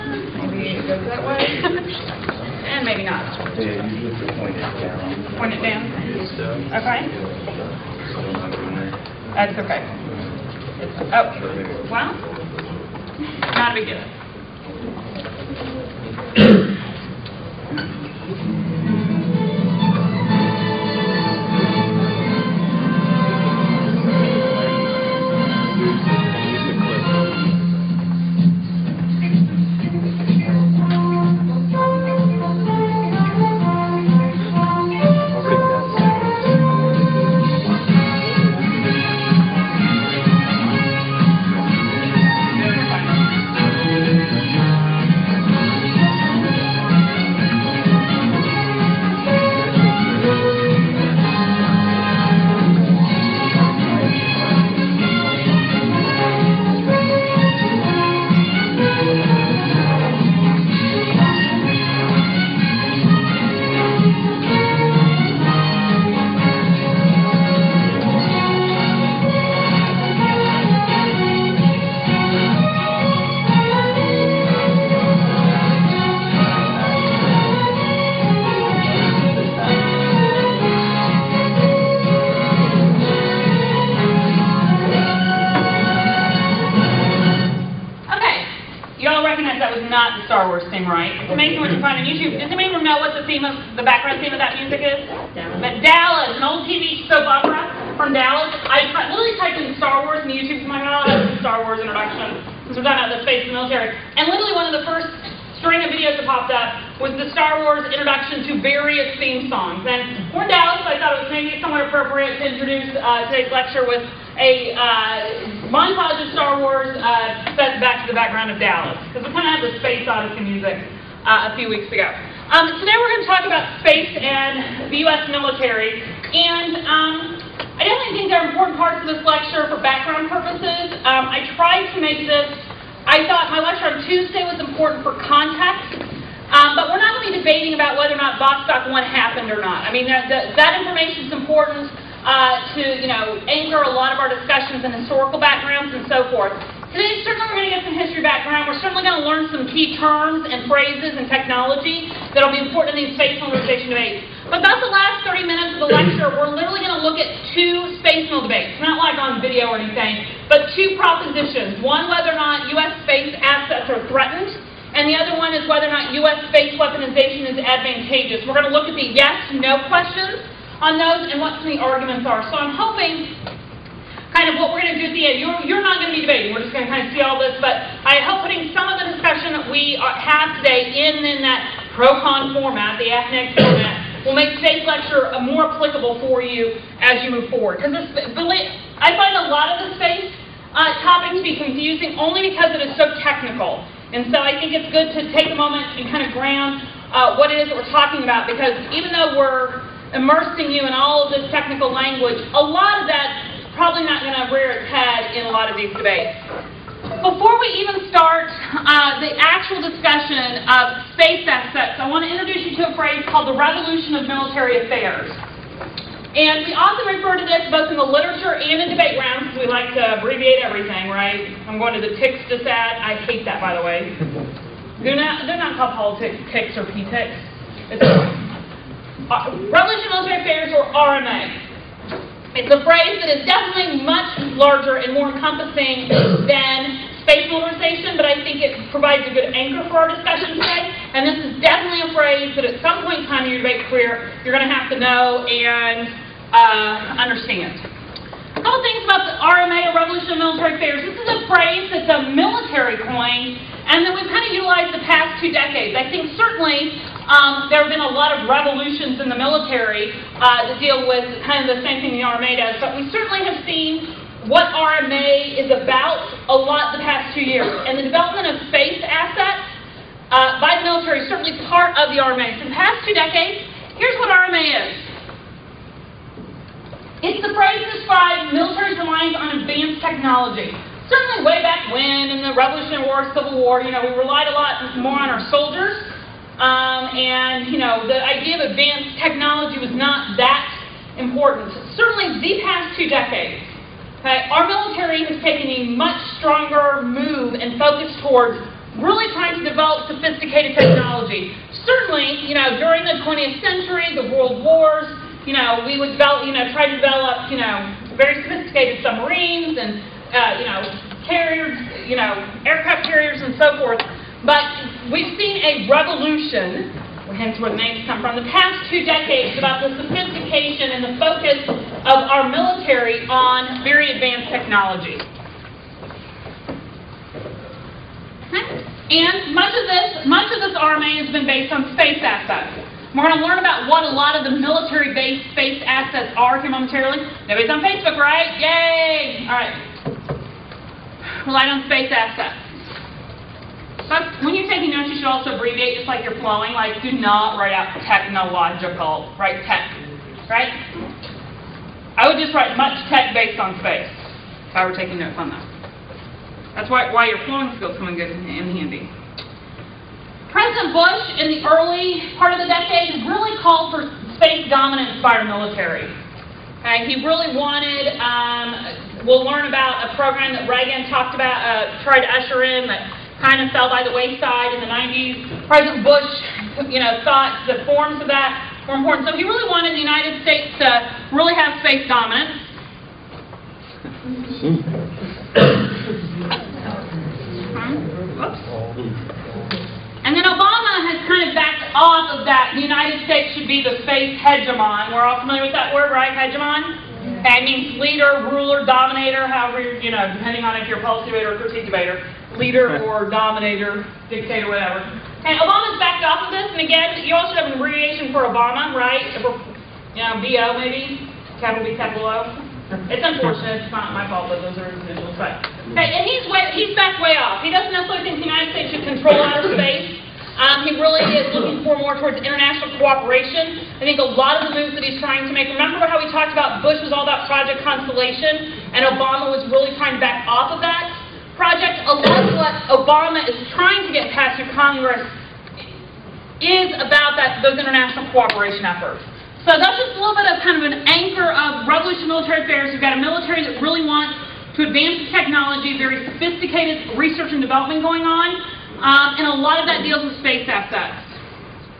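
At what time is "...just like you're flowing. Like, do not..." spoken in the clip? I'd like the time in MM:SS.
05:46.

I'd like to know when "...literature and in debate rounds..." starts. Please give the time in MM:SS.
03:38.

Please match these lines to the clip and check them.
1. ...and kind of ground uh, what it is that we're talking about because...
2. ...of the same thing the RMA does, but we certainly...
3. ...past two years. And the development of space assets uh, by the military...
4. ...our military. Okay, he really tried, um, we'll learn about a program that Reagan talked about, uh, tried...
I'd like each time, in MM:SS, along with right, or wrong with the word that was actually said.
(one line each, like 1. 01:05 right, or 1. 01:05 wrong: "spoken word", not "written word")
1. 03:15 right
2. 04:21 right
3. 04:27 right
4. 06:05 wrong: "wanted", not "tried".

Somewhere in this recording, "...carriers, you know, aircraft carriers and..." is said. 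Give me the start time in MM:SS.
05:11.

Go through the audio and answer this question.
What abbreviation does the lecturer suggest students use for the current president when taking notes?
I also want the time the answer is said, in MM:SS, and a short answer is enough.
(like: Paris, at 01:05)
BO, at 06:50.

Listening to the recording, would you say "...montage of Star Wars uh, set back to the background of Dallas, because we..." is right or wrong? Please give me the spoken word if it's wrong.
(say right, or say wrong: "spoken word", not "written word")
right.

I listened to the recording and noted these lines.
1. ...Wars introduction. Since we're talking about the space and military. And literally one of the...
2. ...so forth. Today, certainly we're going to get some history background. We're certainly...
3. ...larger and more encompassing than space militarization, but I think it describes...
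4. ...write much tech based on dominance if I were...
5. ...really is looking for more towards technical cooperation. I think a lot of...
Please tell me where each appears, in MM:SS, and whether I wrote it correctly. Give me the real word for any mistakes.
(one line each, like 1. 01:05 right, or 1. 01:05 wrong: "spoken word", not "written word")
1. 01:41 right
2. 02:26 right
3. 03:54 wrong: "provides", not "describes"
4. 05:52 wrong: "space", not "dominance"
5. 07:00 wrong: "international", not "technical".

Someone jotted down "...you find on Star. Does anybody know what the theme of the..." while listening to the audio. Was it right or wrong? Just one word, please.
wrong.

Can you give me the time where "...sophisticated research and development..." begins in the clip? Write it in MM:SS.
07:26.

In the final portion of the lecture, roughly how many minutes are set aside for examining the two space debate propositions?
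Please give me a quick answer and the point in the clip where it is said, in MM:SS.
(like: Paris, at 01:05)
30, at 02:35.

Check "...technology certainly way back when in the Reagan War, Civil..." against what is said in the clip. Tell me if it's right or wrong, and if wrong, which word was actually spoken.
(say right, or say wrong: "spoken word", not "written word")
wrong: "Revolutionary", not "Reagan".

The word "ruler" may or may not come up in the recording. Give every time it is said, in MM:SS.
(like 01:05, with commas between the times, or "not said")
06:38.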